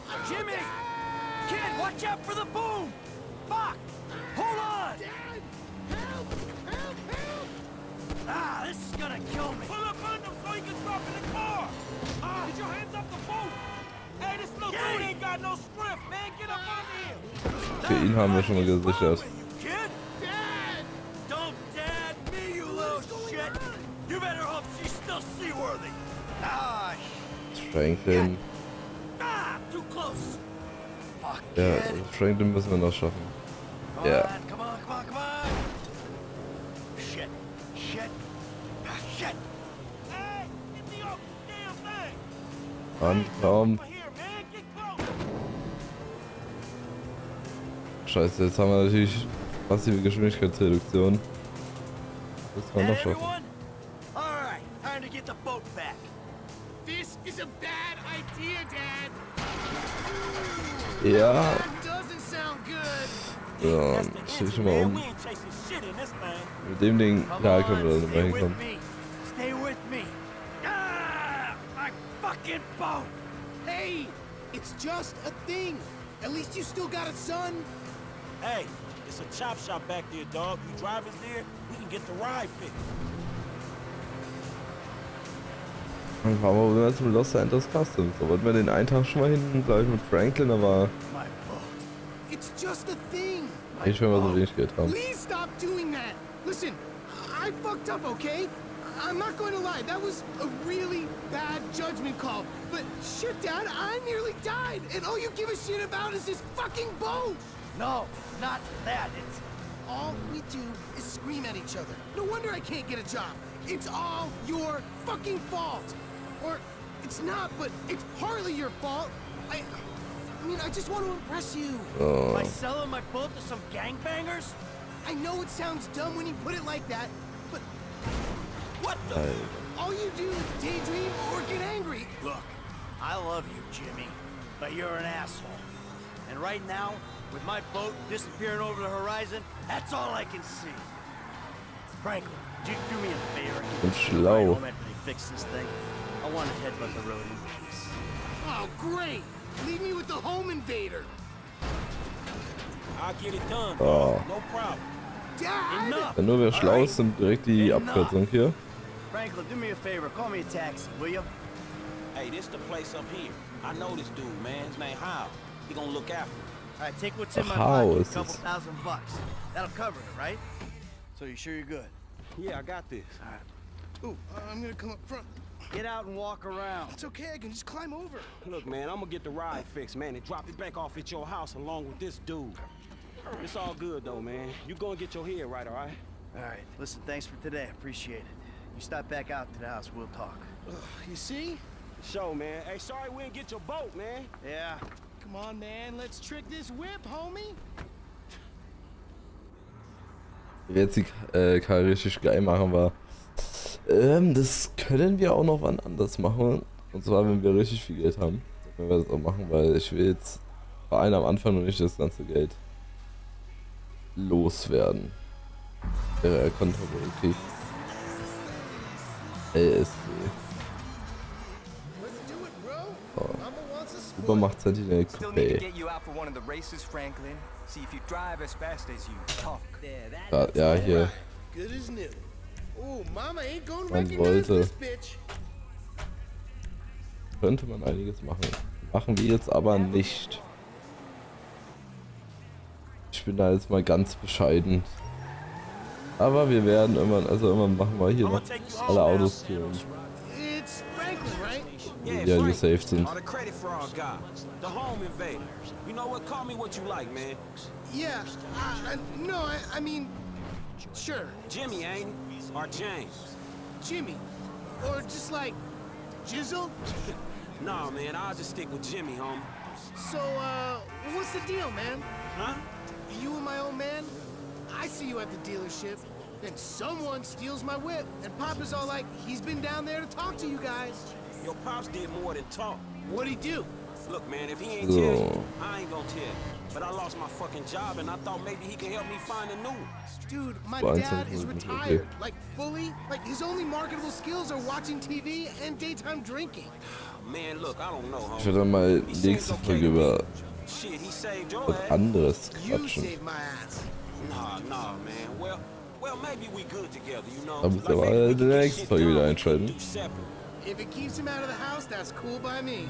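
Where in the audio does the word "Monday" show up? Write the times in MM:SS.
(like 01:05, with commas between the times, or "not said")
not said.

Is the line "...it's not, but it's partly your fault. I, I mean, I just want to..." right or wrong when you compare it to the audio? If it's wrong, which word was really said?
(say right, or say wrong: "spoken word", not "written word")
right.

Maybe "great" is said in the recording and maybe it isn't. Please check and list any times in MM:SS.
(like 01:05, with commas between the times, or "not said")
02:28.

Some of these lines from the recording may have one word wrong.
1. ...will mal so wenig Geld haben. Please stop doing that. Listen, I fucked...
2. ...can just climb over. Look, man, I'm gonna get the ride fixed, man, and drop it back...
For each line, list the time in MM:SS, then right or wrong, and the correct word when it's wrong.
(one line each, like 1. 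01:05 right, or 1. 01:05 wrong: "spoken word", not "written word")
1. 01:34 right
2. 02:57 right.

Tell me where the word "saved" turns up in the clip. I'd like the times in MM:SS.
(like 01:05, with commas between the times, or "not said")
04:12, 05:01.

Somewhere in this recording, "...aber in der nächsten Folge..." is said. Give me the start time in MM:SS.
05:07.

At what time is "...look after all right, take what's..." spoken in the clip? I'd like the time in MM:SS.
02:45.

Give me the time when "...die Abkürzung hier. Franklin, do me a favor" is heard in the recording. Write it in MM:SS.
02:37.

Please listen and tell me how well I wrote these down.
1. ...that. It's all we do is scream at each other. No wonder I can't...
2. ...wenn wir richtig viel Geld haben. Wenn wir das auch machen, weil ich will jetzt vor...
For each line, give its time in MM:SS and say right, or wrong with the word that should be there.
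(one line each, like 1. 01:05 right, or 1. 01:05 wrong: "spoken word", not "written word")
1. 01:48 right
2. 03:27 right.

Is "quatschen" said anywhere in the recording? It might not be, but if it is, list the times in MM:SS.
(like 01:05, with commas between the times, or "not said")
05:02.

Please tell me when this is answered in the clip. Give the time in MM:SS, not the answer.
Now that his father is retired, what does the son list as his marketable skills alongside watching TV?
04:55.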